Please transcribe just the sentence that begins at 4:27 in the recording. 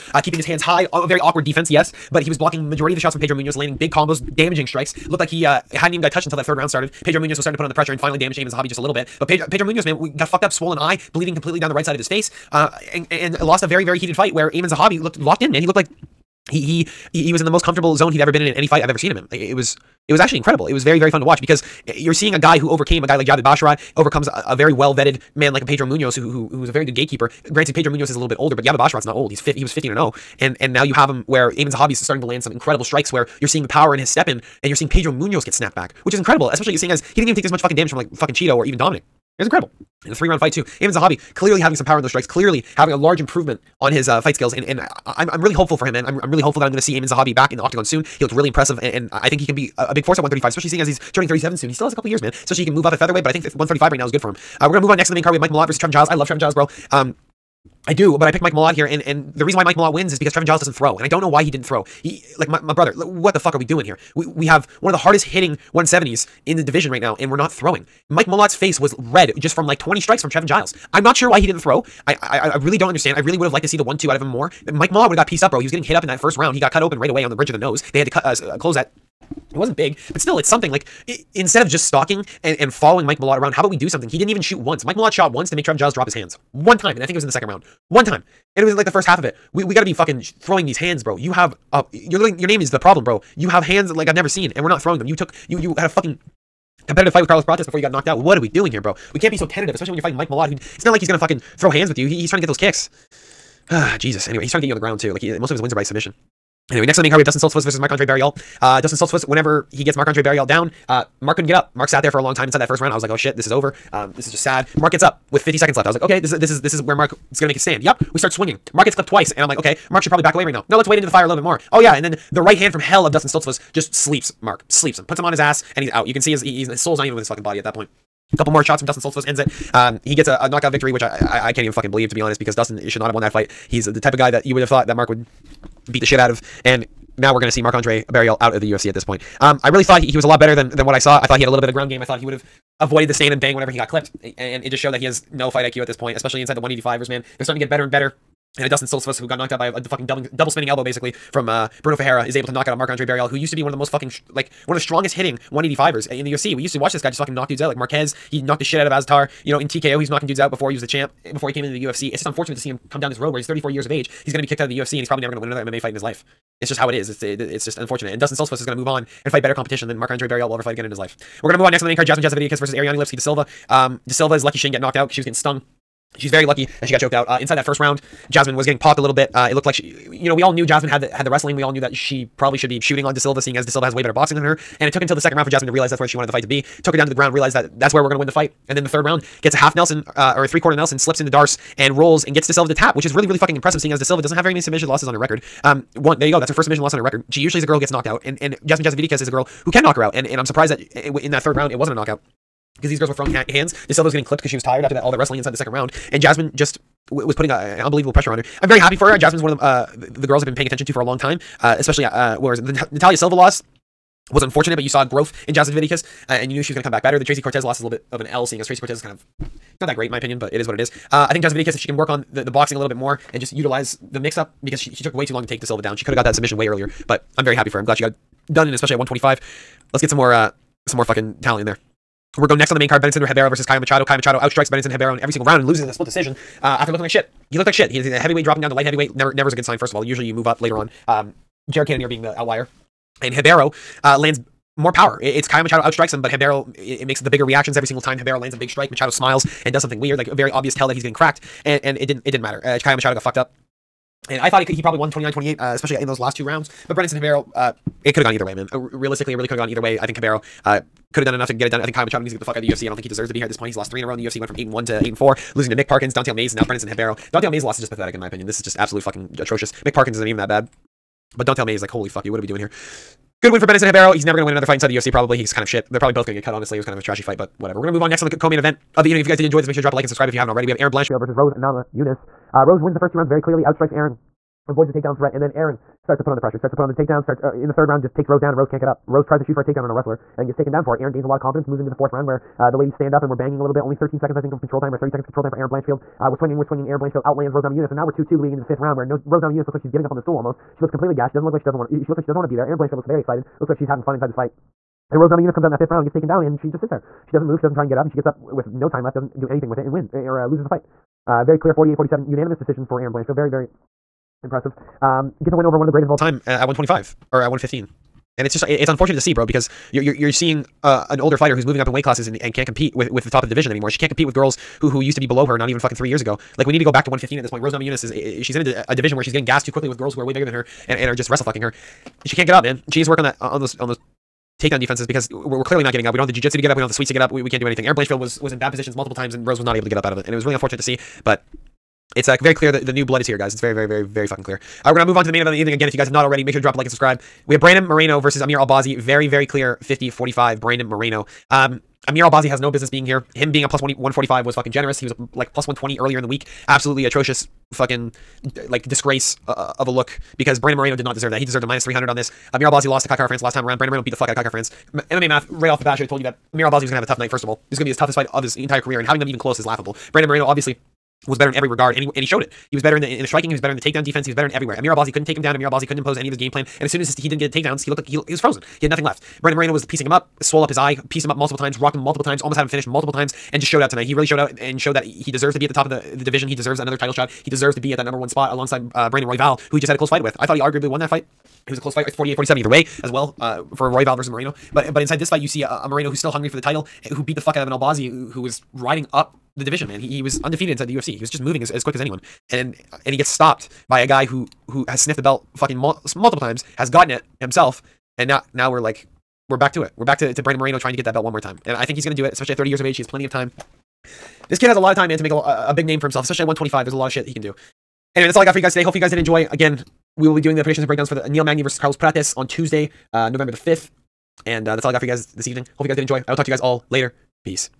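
Dante Mayes' loss is just pathetic in my opinion.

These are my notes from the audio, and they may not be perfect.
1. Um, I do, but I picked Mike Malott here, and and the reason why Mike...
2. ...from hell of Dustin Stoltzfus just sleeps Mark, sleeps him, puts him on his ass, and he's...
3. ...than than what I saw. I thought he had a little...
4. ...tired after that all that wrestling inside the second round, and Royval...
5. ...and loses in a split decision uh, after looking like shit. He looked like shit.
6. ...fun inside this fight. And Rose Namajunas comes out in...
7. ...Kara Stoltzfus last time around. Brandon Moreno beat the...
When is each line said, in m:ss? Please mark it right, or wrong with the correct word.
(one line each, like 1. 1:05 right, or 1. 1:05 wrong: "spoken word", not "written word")
1. 0:56 right
2. 2:02 right
3. 2:20 right
4. 3:24 wrong: "Jasmine", not "Royval"
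5. 3:55 right
6. 5:04 right
7. 6:03 wrong: "France", not "Stoltzfus".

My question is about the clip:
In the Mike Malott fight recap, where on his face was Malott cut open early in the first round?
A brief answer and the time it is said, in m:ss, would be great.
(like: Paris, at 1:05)
Bridge of the nose, at 1:17.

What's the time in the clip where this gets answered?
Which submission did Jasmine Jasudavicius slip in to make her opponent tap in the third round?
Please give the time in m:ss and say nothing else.
3:11.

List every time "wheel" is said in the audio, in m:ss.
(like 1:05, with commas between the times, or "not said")
not said.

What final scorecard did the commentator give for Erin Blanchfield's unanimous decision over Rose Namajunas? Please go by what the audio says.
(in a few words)
48-47.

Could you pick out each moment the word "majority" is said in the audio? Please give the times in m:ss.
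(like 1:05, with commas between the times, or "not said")
0:02.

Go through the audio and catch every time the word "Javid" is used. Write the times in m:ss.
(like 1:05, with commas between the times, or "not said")
0:23, 0:28.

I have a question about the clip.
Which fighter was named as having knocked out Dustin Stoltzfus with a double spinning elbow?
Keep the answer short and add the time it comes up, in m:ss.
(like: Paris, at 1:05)
Bruno Ferreira, at 2:31.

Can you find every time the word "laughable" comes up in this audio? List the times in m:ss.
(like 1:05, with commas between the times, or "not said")
6:09.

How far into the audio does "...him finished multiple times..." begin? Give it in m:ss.
6:22.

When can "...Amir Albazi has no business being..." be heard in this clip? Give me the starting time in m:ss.
5:52.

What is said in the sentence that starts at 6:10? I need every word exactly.
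Brandon Moreno obviously was better in every regard, and he, and he showed it.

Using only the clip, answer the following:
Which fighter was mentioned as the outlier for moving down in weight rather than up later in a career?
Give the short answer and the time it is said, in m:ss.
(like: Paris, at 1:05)
Jared Cannonier, at 4:01.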